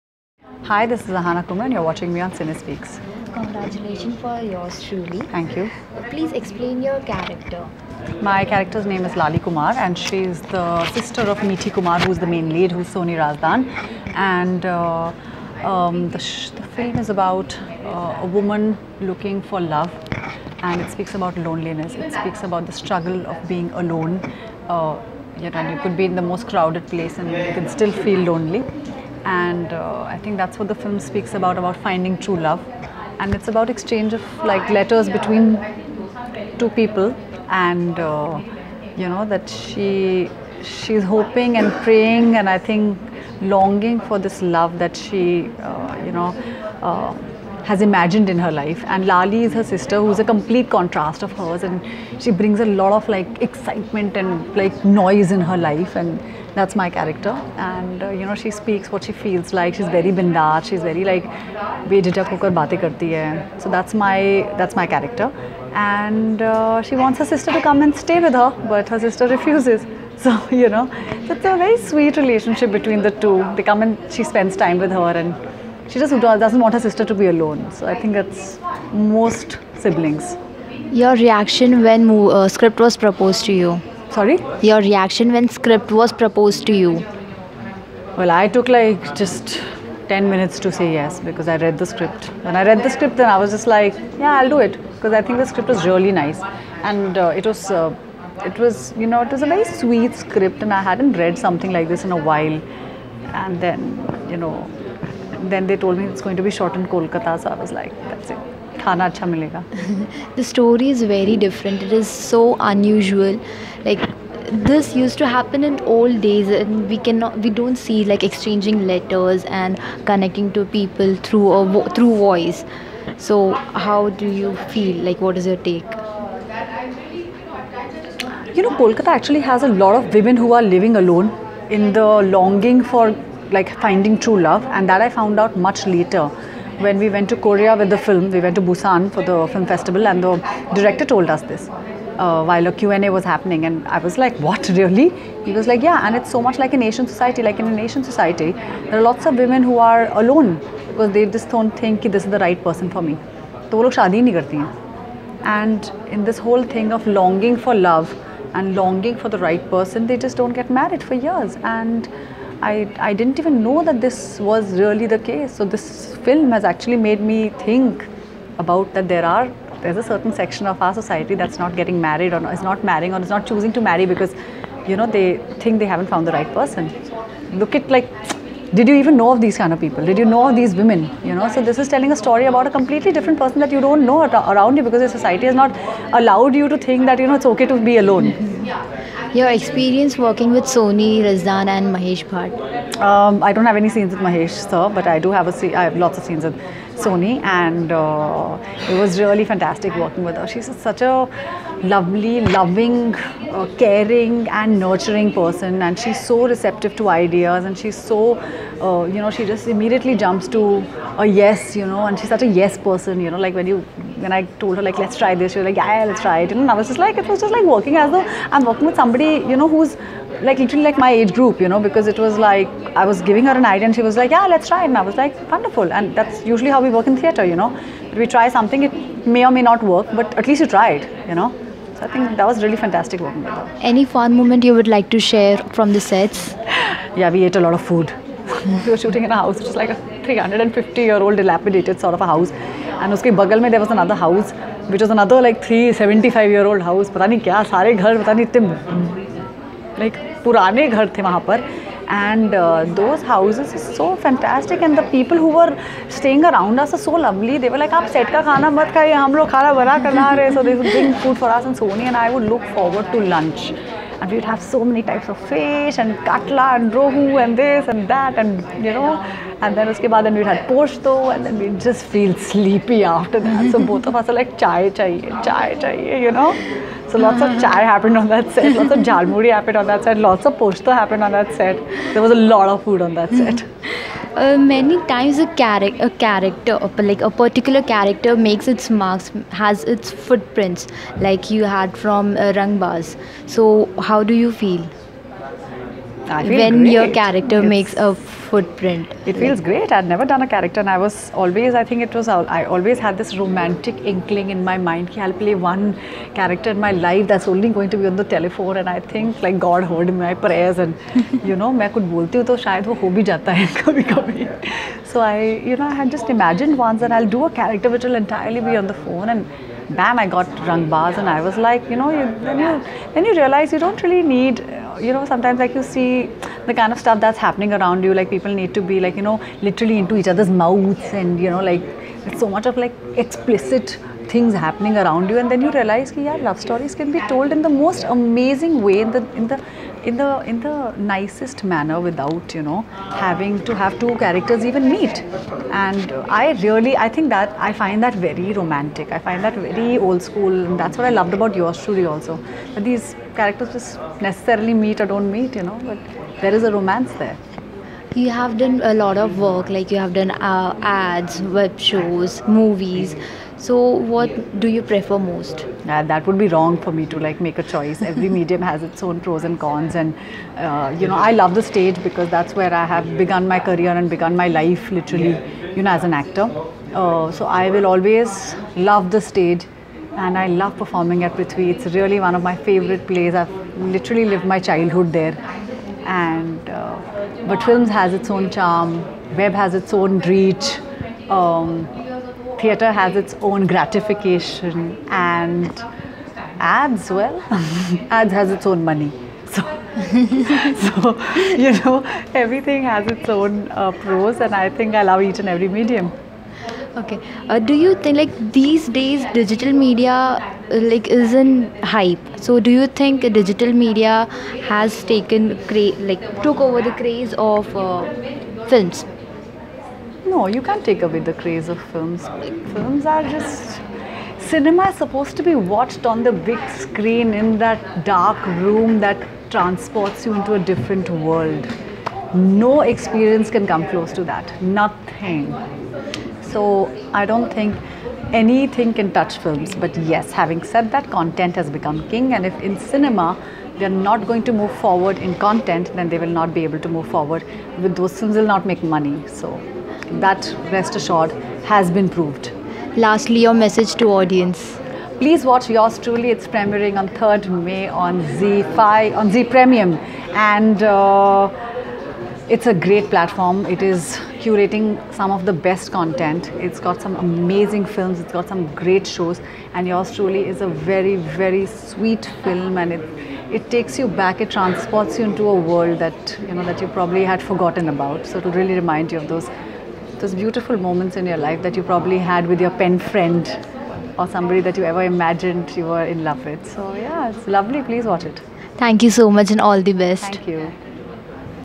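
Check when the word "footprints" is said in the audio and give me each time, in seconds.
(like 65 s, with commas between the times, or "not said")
290 s, 298 s.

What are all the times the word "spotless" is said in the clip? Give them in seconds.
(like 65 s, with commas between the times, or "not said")
not said.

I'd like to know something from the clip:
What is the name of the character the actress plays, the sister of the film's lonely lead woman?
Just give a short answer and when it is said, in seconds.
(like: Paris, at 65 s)
Lali Kumar, at 9 s.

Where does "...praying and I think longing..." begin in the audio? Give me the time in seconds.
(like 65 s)
41 s.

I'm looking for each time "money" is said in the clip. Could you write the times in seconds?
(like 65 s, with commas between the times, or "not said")
398 s, 448 s.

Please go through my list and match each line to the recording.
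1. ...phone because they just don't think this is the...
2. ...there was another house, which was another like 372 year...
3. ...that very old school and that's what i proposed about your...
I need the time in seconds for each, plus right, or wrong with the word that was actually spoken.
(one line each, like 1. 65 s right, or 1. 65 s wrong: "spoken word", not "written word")
1. 150 s wrong: "alone", not "phone"
2. 243 s wrong: "375", not "372"
3. 349 s wrong: "loved", not "proposed".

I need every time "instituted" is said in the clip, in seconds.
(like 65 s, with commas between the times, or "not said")
not said.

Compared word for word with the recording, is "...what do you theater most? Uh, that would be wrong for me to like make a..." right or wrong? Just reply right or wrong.
wrong.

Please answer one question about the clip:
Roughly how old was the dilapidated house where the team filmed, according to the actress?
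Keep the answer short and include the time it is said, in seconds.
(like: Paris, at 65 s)
350 years, at 240 s.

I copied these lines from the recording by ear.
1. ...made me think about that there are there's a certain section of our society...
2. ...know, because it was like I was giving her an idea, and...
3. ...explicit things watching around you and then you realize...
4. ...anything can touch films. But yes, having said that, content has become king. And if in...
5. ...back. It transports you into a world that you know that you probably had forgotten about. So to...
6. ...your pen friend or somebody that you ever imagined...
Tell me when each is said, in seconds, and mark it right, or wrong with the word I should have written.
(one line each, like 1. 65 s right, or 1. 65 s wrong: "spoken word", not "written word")
1. 166 s right
2. 221 s right
3. 333 s wrong: "happening", not "watching"
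4. 438 s right
5. 474 s right
6. 482 s right.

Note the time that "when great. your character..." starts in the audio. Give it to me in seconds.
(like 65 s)
296 s.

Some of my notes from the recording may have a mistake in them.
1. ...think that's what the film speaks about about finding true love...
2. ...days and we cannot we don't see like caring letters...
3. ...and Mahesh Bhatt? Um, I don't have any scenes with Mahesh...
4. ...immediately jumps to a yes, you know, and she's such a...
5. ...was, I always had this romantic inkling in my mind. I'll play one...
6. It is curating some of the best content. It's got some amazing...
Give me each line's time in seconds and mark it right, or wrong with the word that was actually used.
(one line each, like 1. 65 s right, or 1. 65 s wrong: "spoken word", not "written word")
1. 30 s right
2. 116 s wrong: "exchanging", not "caring"
3. 191 s right
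4. 209 s right
5. 302 s right
6. 463 s right.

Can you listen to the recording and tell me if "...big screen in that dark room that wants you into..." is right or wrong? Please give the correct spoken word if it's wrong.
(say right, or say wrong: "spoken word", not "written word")
wrong: "transports", not "wants".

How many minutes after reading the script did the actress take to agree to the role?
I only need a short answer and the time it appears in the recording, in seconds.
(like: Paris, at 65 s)
10, at 90 s.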